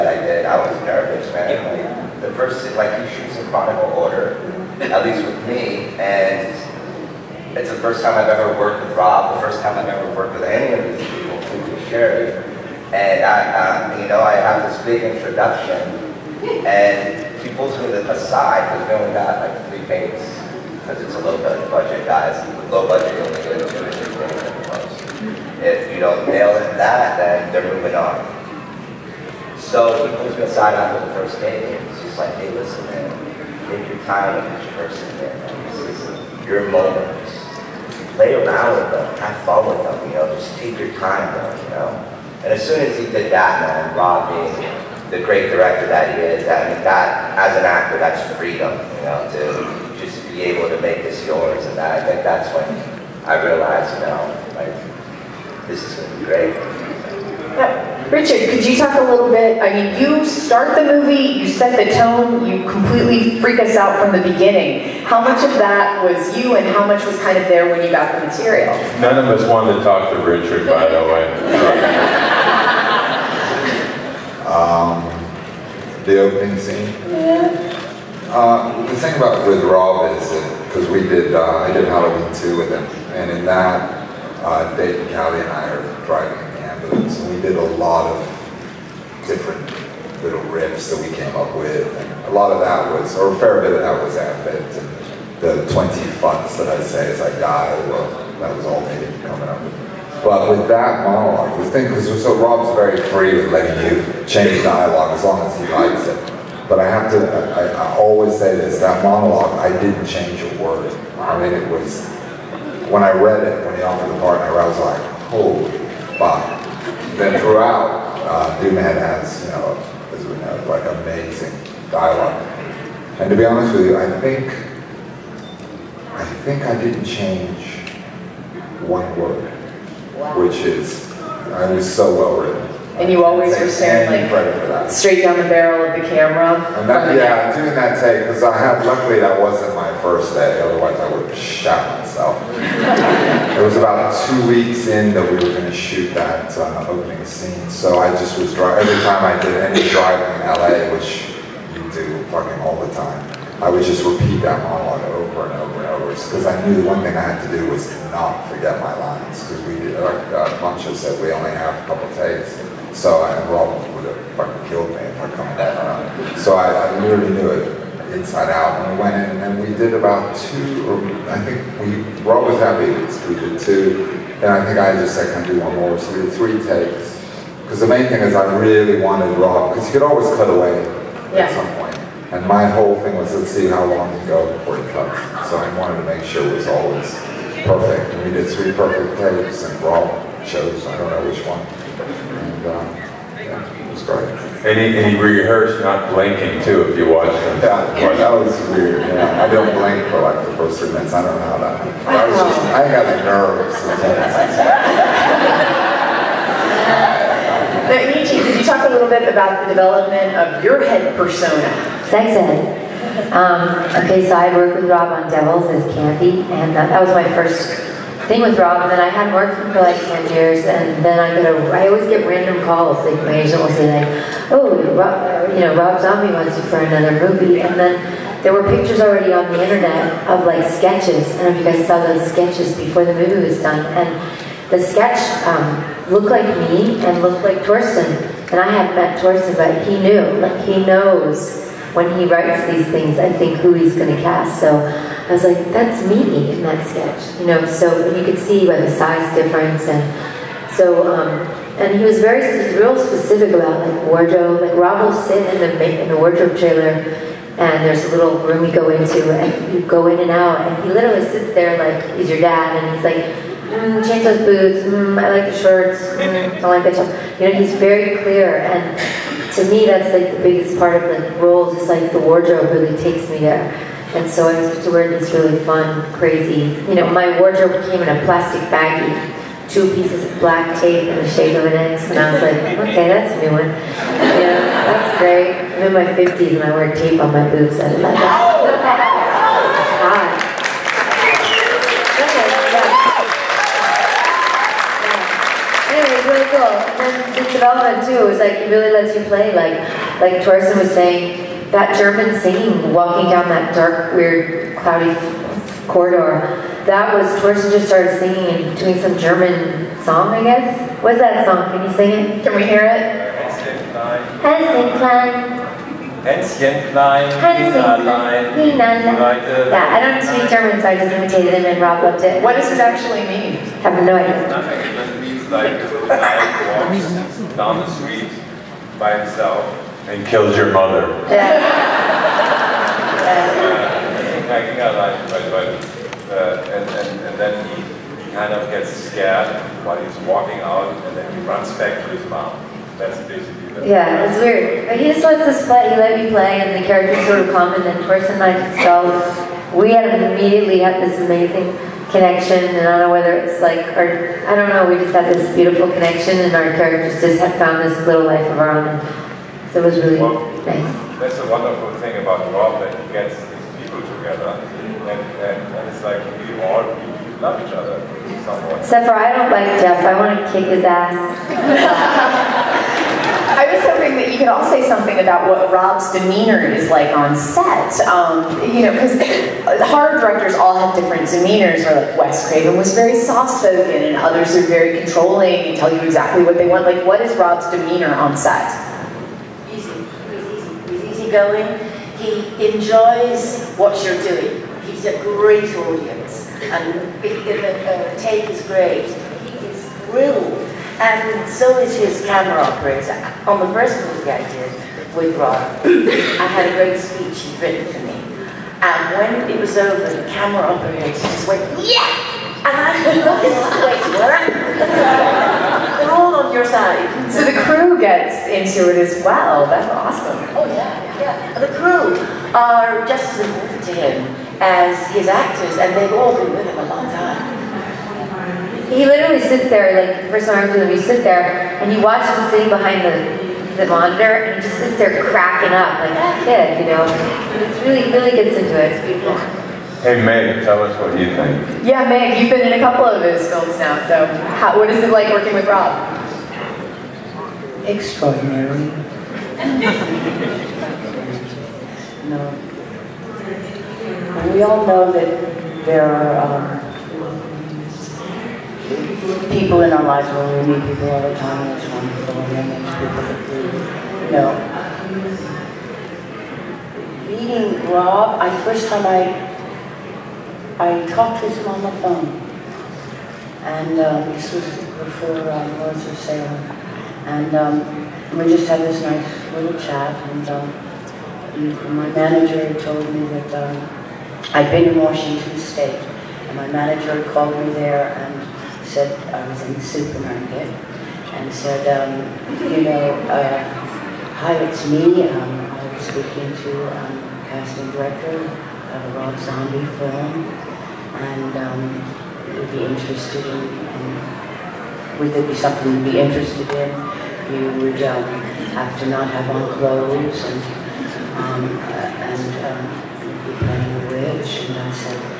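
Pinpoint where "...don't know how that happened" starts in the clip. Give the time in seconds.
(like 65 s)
201 s.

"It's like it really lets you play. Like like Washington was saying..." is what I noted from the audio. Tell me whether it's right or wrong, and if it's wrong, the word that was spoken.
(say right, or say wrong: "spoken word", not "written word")
wrong: "Torsten", not "Washington".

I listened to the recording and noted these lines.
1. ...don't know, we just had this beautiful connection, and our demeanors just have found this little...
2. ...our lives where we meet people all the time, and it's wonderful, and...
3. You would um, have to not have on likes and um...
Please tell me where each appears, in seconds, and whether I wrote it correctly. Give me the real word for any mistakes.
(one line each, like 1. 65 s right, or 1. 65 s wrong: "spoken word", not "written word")
1. 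354 s wrong: "characters", not "demeanors"
2. 459 s right
3. 507 s wrong: "clothes", not "likes".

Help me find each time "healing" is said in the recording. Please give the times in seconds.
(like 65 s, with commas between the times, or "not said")
not said.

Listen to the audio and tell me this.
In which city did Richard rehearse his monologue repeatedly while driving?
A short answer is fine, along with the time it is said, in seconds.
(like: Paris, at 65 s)
LA, at 150 s.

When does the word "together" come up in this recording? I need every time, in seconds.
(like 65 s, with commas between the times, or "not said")
364 s.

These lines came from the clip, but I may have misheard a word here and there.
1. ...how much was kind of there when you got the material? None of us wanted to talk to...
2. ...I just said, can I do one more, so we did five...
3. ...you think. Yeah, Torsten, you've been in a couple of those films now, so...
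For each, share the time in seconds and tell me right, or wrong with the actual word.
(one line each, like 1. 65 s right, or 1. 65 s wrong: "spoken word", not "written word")
1. 66 s right
2. 174 s wrong: "three", not "five"
3. 441 s wrong: "Meg", not "Torsten".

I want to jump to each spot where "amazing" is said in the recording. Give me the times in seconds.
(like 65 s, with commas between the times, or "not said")
121 s, 351 s.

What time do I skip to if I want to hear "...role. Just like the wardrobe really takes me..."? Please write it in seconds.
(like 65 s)
271 s.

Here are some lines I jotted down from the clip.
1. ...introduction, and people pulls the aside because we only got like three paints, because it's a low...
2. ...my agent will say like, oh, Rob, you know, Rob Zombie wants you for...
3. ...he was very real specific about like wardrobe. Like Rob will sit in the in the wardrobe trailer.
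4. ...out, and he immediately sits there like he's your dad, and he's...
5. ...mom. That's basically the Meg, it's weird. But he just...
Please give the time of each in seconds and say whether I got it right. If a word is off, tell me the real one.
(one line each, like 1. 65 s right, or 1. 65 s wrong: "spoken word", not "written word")
1. 15 s right
2. 223 s right
3. 251 s right
4. 260 s wrong: "literally", not "immediately"
5. 342 s wrong: "Yeah", not "Meg".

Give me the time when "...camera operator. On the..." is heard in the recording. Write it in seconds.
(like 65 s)
402 s.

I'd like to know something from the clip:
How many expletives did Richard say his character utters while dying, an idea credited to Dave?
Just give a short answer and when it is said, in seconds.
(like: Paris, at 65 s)
20, at 95 s.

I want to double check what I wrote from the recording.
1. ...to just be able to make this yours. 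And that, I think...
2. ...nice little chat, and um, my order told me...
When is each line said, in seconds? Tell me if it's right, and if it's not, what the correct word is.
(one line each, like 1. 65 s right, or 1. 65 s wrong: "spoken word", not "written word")
1. 49 s right
2. 479 s wrong: "manager", not "order".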